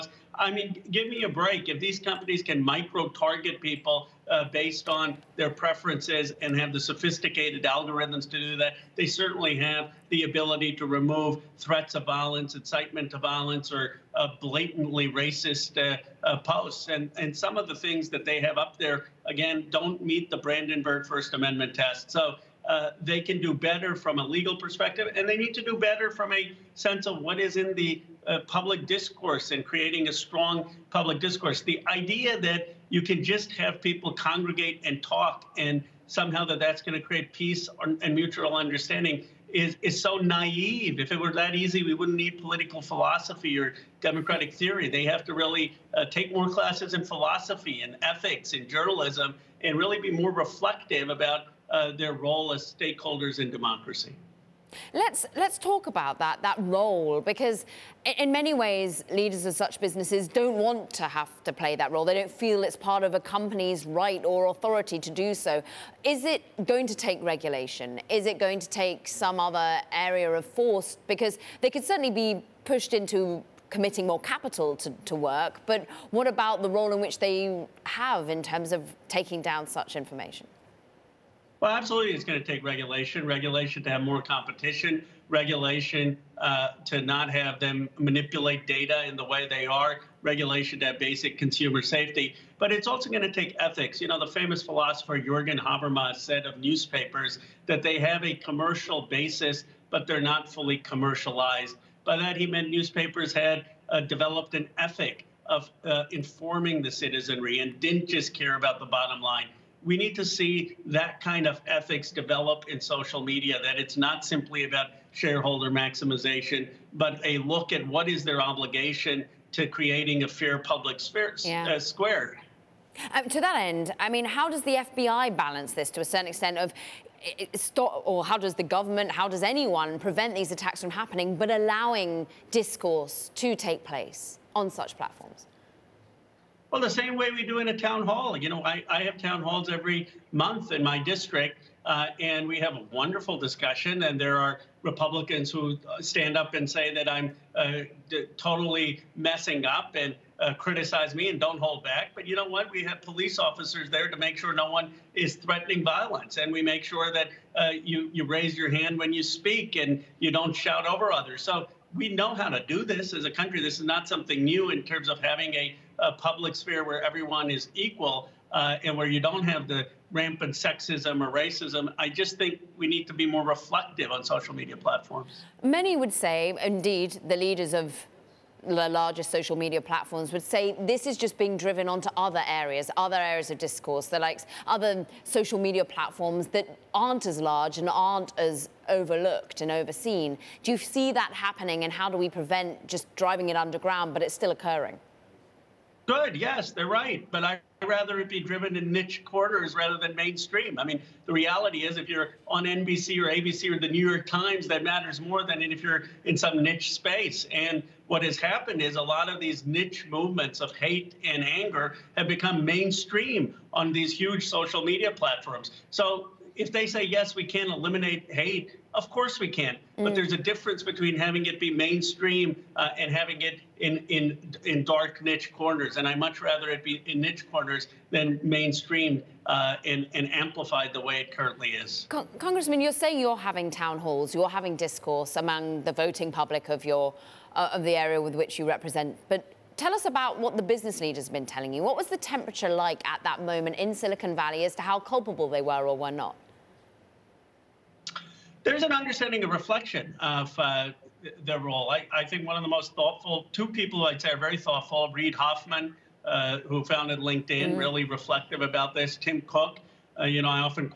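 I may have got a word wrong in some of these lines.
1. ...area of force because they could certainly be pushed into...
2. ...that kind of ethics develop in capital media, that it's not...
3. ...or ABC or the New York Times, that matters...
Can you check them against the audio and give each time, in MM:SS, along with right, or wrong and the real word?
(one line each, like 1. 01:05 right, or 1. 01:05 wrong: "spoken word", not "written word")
1. 01:09 right
2. 01:50 wrong: "social", not "capital"
3. 03:23 right.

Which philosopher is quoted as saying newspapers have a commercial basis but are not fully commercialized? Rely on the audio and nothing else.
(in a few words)
Jurgen Habermas.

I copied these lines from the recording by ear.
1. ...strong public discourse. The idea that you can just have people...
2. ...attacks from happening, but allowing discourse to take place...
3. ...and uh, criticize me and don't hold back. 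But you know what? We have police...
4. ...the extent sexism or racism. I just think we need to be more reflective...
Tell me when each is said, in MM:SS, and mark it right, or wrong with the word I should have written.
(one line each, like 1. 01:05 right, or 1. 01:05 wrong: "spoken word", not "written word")
1. 00:30 right
2. 02:10 right
3. 02:29 right
4. 02:49 wrong: "rampant", not "extent".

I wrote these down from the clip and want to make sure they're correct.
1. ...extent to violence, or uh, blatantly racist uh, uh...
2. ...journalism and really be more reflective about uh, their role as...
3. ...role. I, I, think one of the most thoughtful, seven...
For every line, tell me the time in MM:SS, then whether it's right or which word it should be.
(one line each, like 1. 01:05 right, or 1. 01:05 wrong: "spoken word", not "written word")
1. 00:12 wrong: "incitement", not "extent"
2. 00:48 right
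3. 04:11 wrong: "two", not "seven".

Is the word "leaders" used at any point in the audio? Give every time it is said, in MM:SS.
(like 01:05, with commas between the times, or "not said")
00:59, 02:57, 04:00.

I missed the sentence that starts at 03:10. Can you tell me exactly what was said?
Do you see that happening and how do we prevent just driving it underground, but it's still occurring?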